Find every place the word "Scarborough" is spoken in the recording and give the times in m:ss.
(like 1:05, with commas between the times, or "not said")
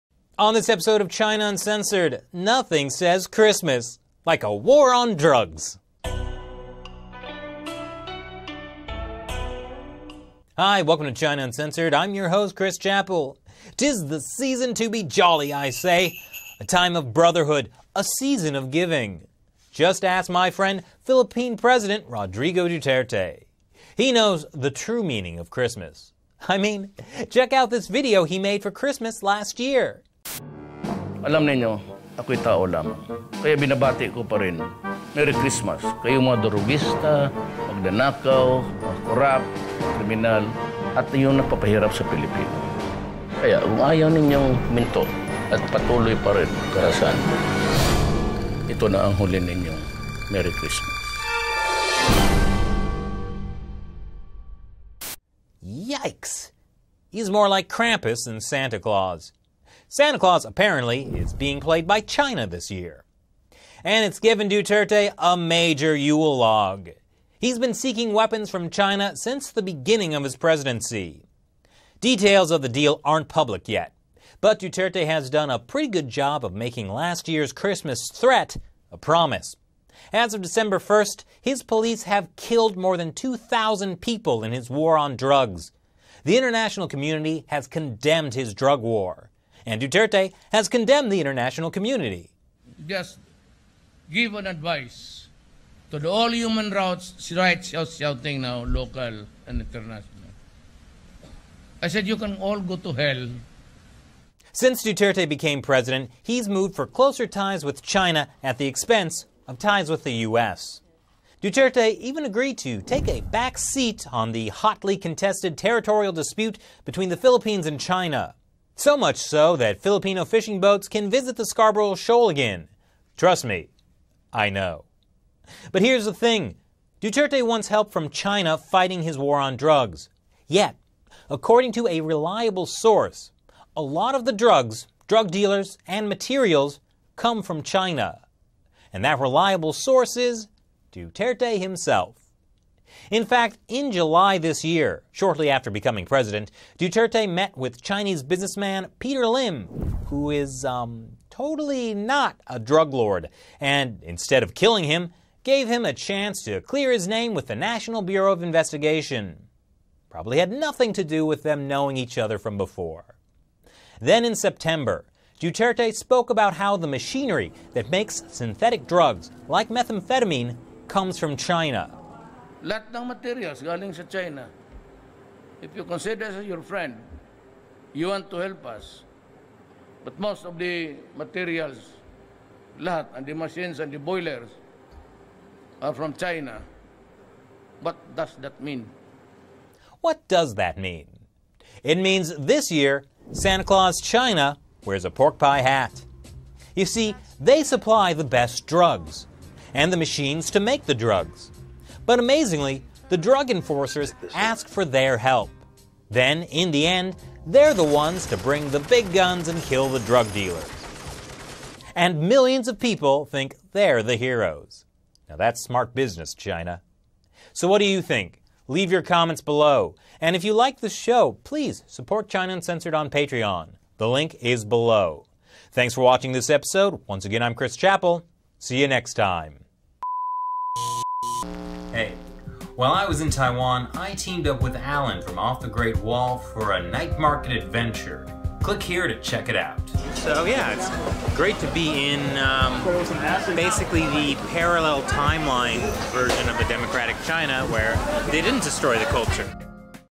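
2:01.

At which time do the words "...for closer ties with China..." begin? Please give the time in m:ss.
1:46.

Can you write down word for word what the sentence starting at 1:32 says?
Just give an advice to the all human rights, rights shouting now, local and international.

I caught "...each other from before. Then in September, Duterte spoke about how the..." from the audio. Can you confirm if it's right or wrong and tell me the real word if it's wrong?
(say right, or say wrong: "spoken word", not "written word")
right.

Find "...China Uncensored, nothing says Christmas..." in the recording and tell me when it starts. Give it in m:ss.
0:01.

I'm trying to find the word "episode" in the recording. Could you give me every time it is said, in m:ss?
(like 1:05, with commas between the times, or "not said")
0:00, 3:46.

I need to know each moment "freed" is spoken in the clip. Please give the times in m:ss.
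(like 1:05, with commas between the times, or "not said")
not said.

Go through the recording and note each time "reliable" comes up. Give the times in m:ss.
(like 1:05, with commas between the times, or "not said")
2:12, 2:19.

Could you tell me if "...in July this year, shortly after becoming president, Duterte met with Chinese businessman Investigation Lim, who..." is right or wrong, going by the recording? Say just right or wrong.
wrong.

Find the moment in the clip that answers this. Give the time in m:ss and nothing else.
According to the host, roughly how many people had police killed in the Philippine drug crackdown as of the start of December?
1:22.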